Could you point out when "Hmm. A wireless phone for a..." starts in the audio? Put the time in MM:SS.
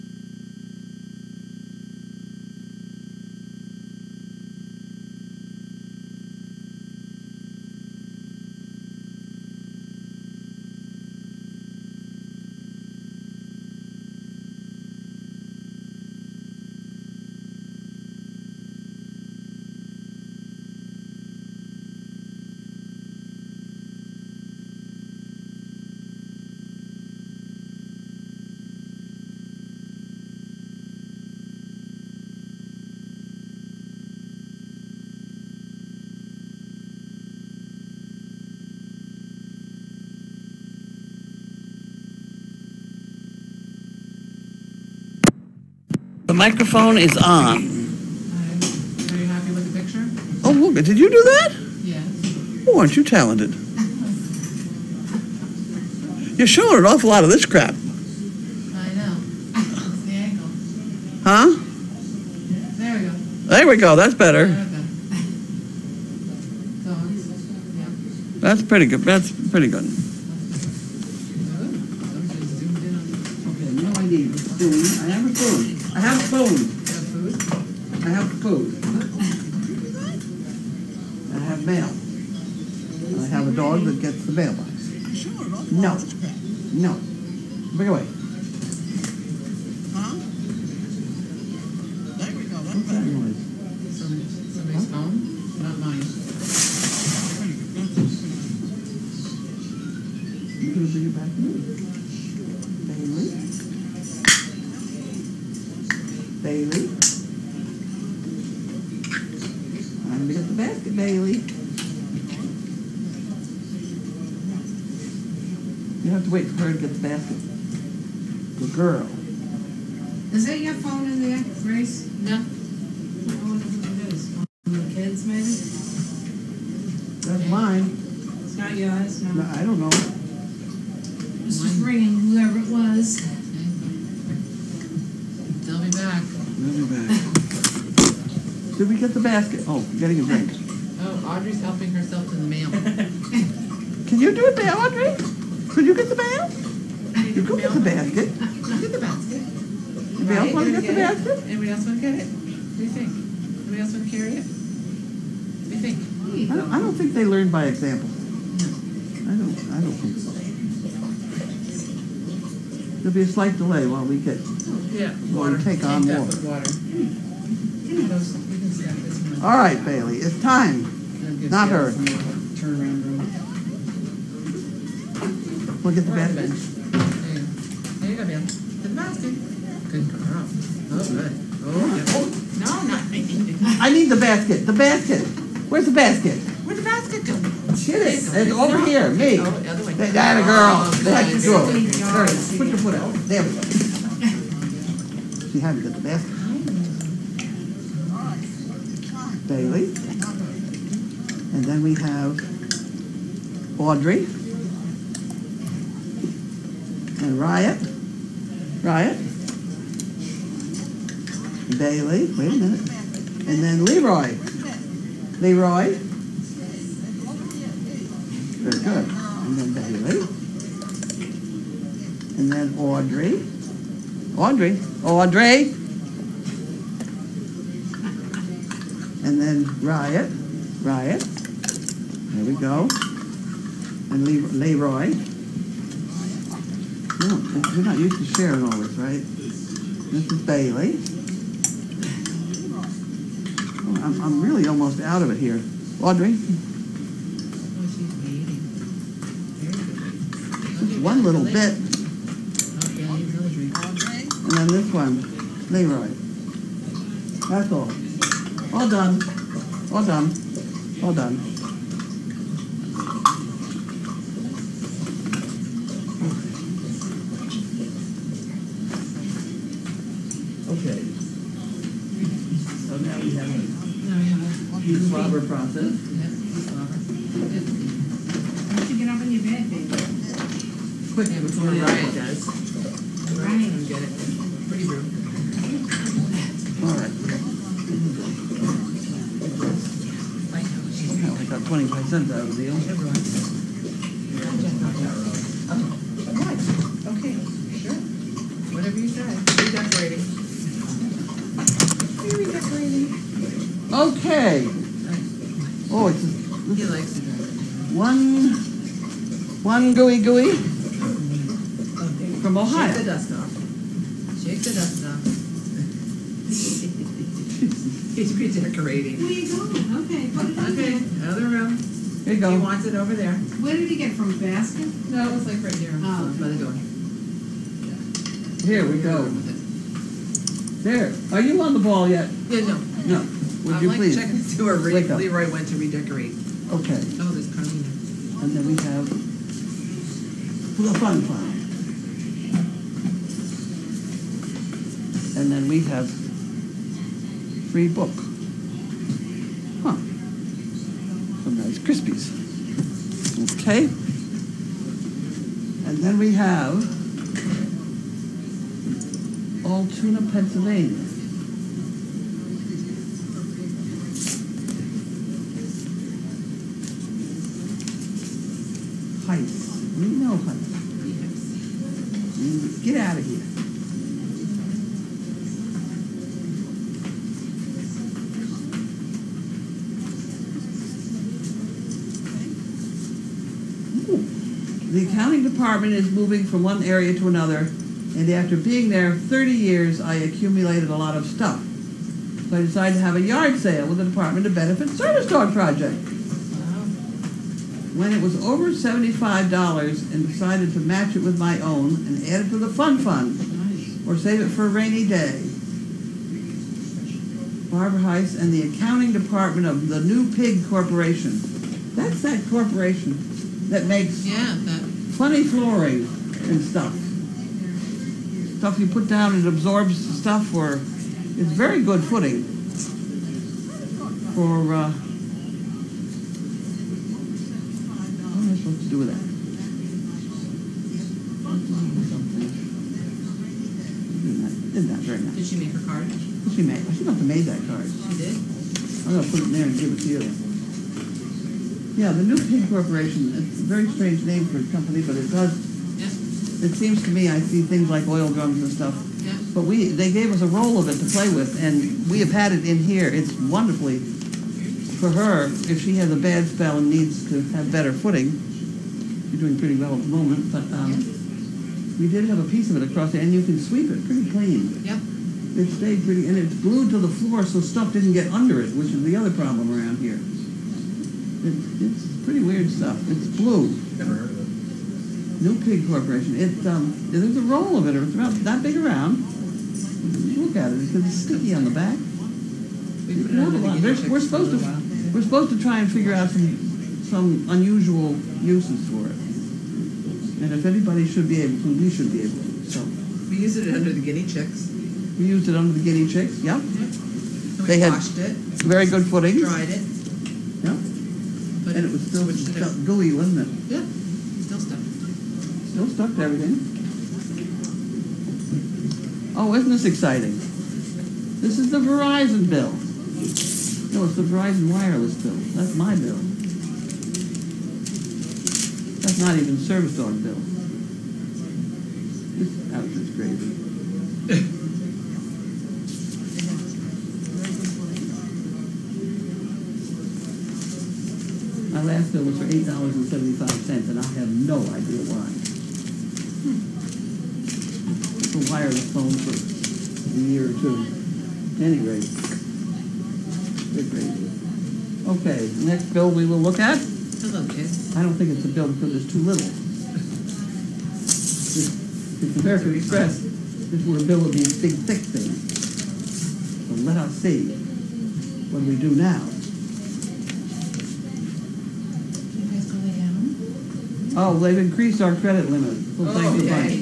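08:56.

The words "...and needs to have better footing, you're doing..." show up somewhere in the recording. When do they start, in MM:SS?
07:36.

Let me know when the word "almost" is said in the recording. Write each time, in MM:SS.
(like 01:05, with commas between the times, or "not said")
04:04.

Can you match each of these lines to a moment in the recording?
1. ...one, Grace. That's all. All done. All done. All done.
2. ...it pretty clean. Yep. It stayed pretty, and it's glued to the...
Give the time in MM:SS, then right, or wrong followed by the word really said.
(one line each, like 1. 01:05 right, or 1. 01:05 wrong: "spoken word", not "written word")
1. 04:14 wrong: "Leroy", not "Grace"
2. 07:43 right.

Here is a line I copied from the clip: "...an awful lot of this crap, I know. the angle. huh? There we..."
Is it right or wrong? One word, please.
right.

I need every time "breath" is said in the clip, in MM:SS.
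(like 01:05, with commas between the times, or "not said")
not said.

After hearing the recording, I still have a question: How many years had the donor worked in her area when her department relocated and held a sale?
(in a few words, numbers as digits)
30.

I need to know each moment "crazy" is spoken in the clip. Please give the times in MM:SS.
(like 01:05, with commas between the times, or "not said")
08:43.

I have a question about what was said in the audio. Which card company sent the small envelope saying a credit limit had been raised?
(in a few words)
American Express.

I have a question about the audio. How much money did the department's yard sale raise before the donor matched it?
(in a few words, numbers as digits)
$75.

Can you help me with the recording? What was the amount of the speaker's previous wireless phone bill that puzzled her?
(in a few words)
$8.75.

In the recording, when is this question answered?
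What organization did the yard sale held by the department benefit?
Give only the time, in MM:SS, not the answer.
06:34.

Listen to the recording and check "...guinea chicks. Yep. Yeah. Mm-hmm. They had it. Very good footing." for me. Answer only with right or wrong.
right.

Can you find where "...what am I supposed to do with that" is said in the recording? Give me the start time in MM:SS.
07:08.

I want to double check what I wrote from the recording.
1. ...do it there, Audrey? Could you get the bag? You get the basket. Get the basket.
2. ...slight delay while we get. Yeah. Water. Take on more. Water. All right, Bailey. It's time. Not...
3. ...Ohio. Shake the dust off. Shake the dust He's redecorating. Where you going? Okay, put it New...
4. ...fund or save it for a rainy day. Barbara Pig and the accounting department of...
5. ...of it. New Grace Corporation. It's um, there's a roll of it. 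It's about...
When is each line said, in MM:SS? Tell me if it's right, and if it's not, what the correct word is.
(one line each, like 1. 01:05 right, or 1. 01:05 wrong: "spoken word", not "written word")
1. 02:24 right
2. 02:43 right
3. 05:12 wrong: "Okay", not "New"
4. 06:42 wrong: "Heiss", not "Pig"
5. 07:54 wrong: "Pig", not "Grace".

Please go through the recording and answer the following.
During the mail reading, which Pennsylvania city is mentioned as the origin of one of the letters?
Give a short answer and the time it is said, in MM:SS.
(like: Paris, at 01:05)
Altoona, at 05:59.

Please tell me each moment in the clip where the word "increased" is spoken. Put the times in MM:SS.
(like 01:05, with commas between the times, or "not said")
09:24.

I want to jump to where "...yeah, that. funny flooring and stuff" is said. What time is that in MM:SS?
06:54.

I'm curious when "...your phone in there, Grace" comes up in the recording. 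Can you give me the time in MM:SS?
02:00.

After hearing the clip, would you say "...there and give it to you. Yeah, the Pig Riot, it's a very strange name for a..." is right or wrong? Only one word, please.
wrong.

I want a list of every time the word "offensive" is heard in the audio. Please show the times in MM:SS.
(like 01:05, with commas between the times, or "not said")
not said.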